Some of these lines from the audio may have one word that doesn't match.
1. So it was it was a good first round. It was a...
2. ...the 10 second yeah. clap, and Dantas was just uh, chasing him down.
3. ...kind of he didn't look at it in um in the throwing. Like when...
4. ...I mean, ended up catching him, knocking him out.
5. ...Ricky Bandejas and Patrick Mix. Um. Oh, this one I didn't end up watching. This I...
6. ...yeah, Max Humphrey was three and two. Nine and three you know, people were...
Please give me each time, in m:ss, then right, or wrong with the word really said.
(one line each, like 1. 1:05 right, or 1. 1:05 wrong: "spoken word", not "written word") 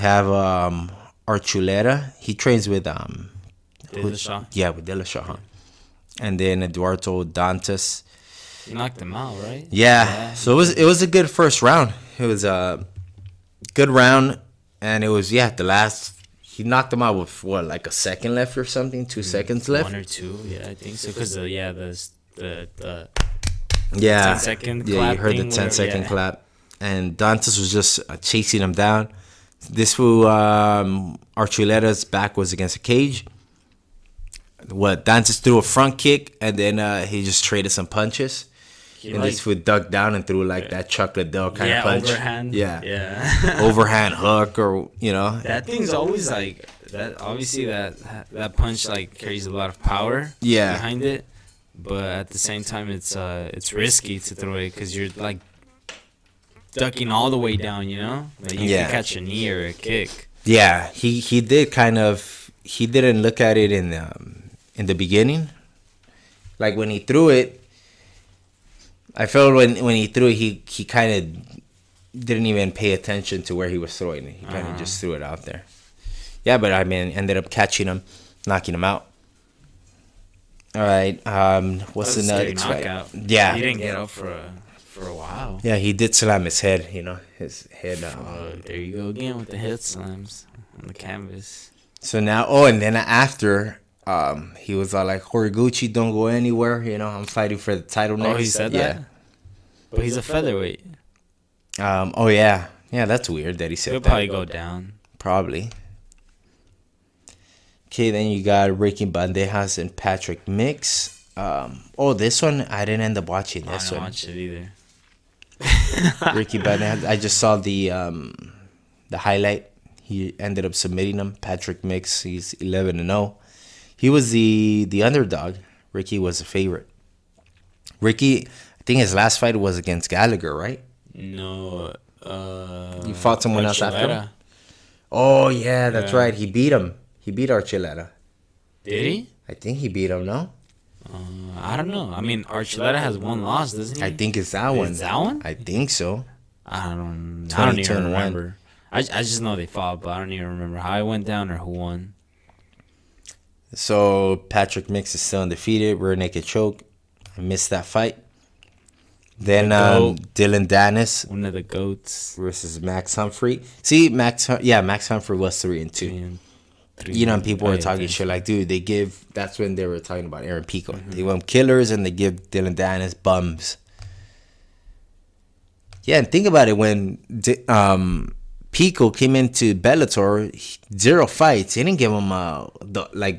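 1. 0:10 right
2. 0:25 right
3. 1:01 wrong: "beginning", not "throwing"
4. 1:16 right
5. 1:48 right
6. 2:44 wrong: "Three", not "Nine".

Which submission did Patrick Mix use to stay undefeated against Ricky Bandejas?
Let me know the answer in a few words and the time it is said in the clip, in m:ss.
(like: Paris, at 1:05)
Rear naked choke, at 2:35.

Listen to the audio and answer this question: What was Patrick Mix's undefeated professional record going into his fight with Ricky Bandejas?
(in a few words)
11-0.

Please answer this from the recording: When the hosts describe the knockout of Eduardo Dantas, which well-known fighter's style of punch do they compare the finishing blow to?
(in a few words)
Chuck Liddell.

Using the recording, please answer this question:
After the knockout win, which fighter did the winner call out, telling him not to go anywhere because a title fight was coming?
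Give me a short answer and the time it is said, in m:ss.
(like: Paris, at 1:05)
Horiguchi, at 1:35.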